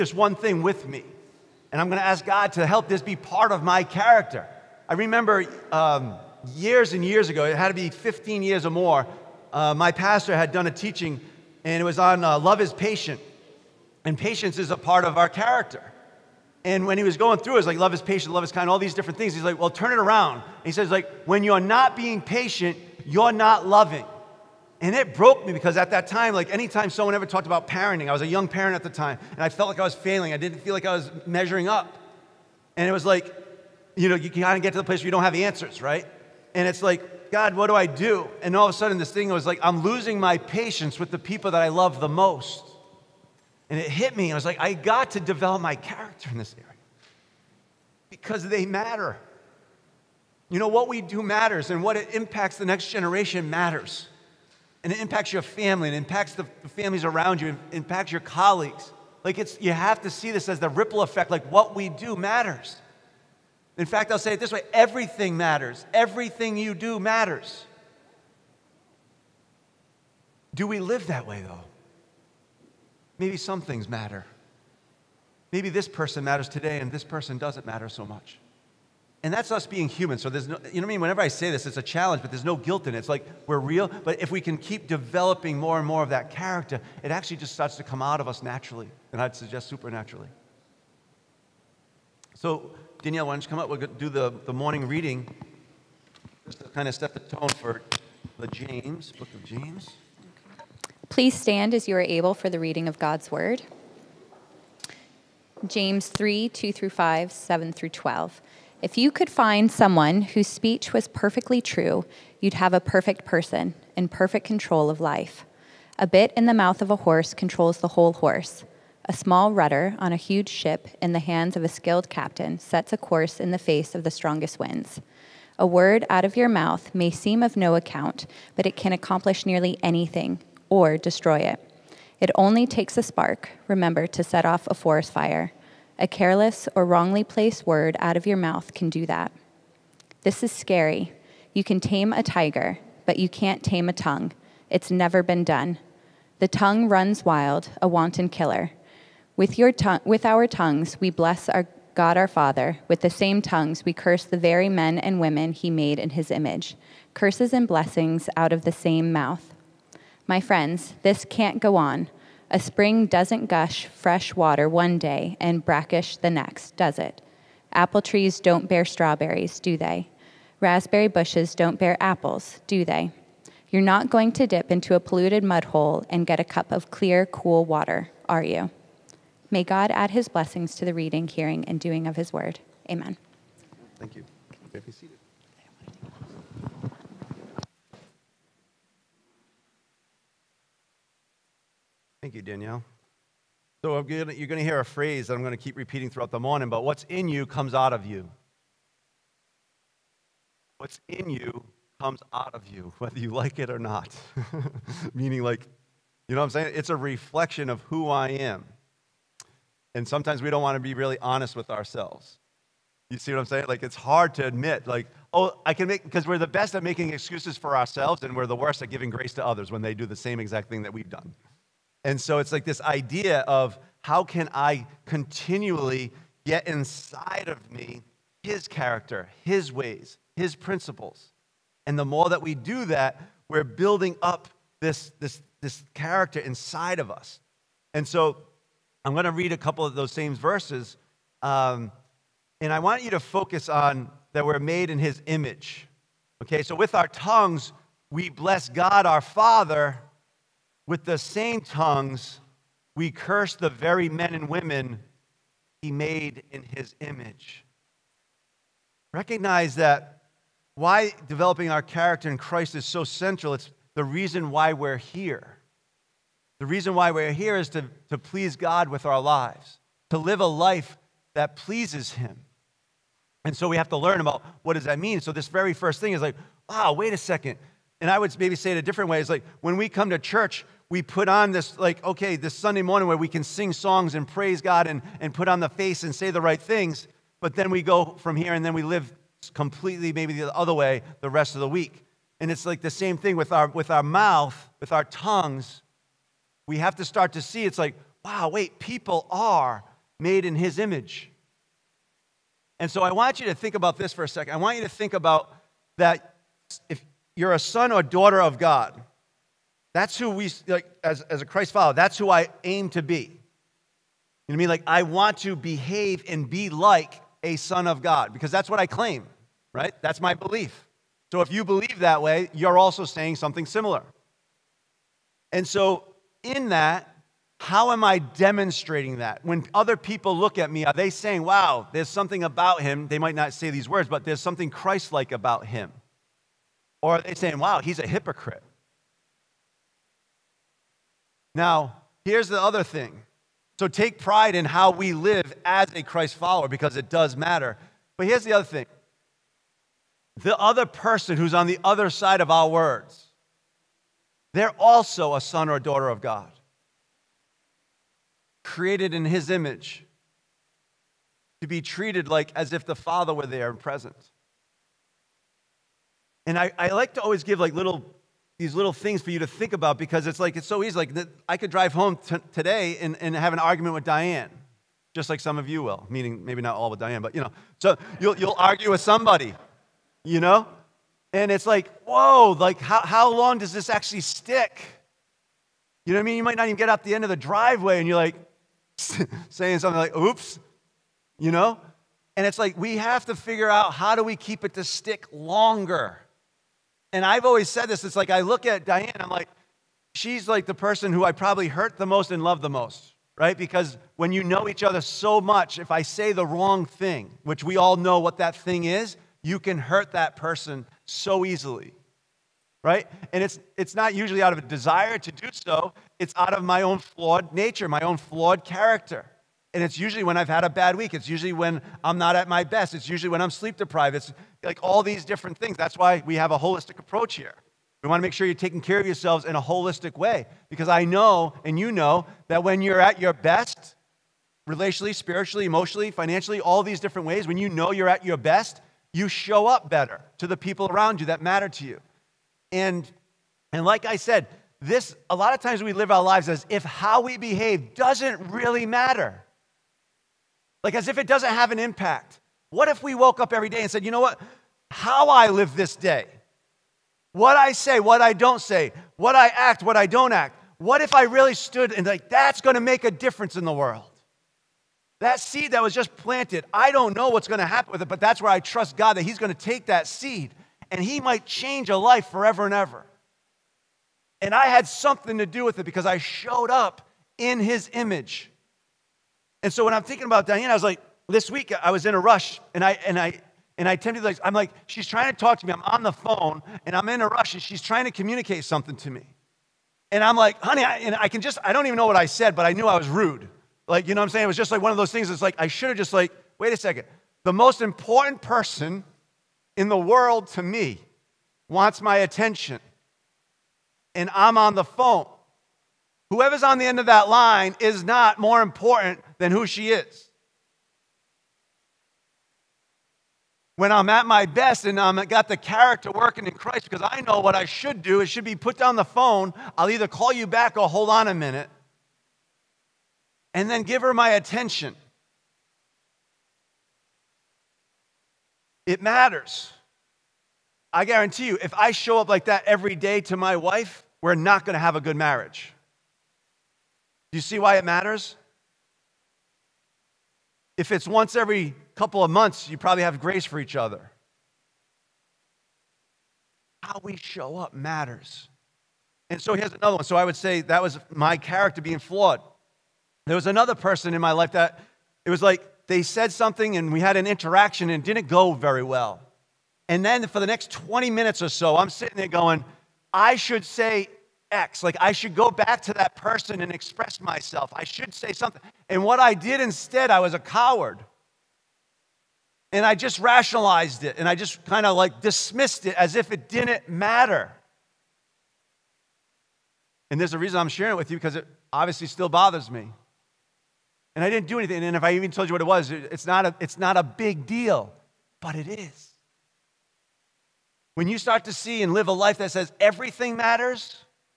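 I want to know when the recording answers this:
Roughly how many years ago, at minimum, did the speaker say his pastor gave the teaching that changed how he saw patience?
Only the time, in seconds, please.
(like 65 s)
7 s.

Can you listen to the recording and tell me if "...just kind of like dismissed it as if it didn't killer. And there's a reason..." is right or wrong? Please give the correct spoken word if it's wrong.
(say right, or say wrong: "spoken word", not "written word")
wrong: "matter", not "killer".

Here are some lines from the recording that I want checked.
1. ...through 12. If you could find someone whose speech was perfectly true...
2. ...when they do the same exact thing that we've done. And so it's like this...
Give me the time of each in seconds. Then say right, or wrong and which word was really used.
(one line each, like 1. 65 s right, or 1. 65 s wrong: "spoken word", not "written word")
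1. 107 s right
2. 219 s right.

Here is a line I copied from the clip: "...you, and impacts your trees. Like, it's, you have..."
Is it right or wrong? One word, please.
wrong.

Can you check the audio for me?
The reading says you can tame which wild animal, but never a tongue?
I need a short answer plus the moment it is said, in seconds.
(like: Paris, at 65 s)
tiger, at 142 s.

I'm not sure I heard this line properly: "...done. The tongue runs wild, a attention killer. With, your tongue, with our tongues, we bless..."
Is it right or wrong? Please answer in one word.
wrong.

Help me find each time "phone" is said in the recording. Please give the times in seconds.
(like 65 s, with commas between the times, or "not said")
486 s, 504 s, 519 s.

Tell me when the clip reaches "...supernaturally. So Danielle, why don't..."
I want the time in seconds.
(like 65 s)
89 s.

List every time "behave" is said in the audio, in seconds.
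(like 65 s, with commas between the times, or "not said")
315 s, 447 s.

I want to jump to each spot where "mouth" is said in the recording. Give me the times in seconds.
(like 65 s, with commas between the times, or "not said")
116 s, 126 s, 138 s, 159 s, 294 s.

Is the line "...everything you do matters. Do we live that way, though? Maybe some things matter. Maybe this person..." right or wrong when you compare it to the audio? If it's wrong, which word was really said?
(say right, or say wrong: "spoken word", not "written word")
right.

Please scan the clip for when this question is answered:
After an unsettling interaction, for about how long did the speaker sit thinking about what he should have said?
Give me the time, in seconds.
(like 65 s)
560 s.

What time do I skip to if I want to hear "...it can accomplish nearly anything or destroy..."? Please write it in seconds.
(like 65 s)
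128 s.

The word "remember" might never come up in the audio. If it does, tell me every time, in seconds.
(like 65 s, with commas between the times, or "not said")
4 s, 133 s.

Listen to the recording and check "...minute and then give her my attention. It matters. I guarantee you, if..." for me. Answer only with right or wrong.
right.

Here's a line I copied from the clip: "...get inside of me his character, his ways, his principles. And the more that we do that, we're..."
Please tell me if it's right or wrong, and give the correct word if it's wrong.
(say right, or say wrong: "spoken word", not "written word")
right.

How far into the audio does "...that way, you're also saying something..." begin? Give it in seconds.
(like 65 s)
322 s.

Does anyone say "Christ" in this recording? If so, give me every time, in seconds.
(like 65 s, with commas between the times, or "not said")
262 s, 311 s, 334 s, 346 s, 516 s.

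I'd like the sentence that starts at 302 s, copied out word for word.
And so I want you to think about this for a second.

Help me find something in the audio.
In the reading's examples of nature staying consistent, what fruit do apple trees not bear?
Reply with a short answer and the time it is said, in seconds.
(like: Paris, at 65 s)
strawberries, at 168 s.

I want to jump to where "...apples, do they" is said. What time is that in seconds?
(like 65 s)
172 s.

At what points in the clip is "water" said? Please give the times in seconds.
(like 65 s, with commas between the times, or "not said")
164 s, 177 s.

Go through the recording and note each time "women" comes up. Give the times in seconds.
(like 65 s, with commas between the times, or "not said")
155 s, 254 s.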